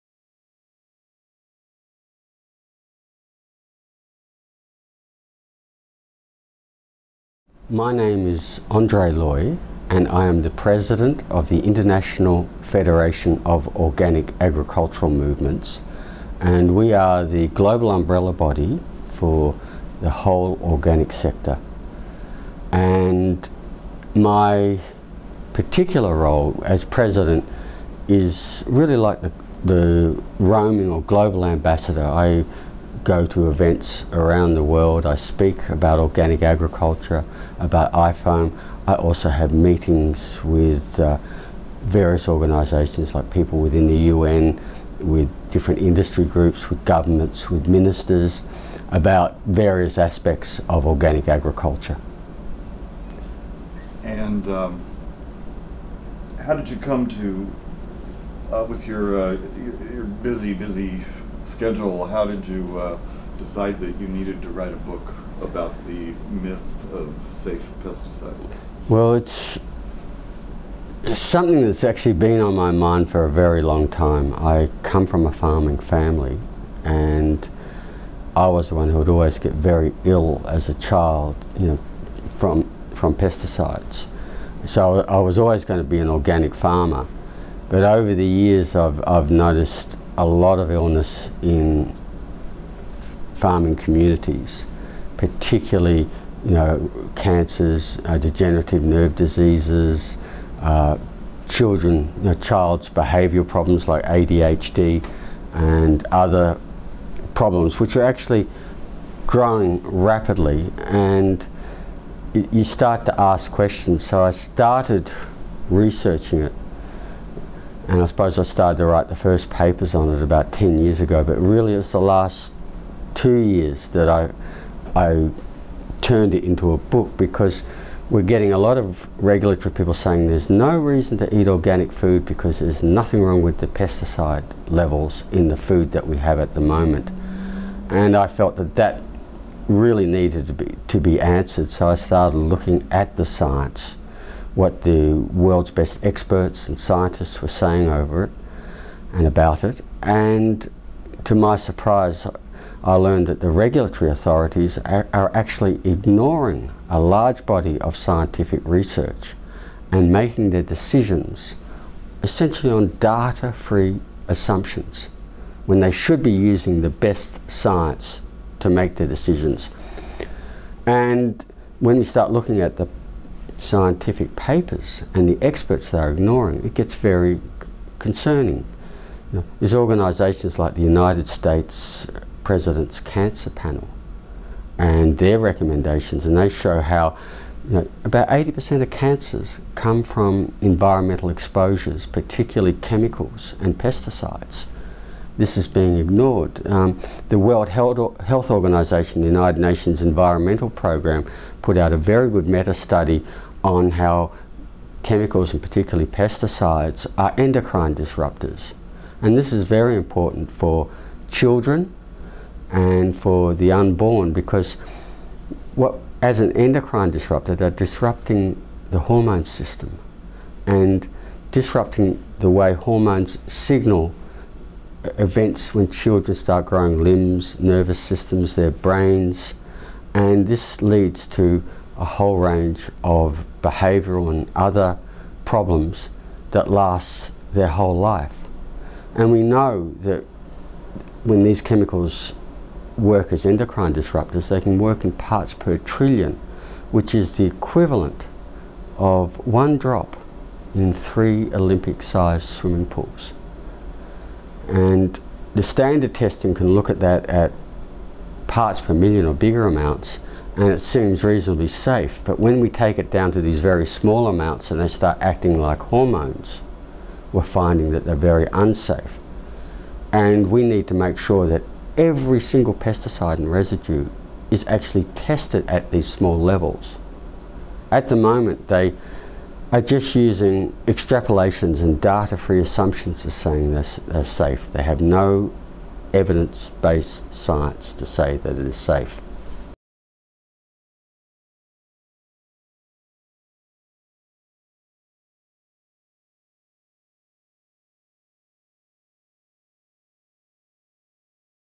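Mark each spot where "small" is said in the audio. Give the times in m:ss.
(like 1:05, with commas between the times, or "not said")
4:23, 4:36.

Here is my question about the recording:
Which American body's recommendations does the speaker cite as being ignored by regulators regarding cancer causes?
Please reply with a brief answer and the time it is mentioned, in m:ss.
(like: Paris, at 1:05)
United States President's Cancer Panel, at 3:00.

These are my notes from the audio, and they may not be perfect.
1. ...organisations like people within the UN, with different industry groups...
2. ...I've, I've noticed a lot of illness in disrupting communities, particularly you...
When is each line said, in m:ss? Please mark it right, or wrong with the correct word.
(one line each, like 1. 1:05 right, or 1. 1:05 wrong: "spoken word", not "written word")
1. 0:42 right
2. 1:28 wrong: "farming", not "disrupting".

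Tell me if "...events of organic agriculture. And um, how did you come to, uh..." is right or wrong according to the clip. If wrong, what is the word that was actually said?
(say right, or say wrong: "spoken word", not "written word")
wrong: "aspects", not "events".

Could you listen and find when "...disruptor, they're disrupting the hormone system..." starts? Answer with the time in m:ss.
3:37.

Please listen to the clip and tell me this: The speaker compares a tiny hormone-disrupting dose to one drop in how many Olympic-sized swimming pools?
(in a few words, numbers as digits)
3.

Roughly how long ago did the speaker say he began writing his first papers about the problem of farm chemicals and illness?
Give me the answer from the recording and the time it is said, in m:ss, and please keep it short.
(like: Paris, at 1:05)
10 years, at 2:00.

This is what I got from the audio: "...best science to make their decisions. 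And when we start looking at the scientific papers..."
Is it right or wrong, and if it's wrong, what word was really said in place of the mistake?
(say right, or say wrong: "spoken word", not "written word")
right.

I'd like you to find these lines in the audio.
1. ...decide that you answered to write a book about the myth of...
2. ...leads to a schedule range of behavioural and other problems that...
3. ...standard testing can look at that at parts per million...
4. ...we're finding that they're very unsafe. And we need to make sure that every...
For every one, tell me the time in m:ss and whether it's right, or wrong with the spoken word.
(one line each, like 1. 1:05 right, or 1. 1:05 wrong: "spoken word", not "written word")
1. 1:03 wrong: "needed", not "answered"
2. 3:50 wrong: "whole", not "schedule"
3. 4:15 right
4. 4:27 right.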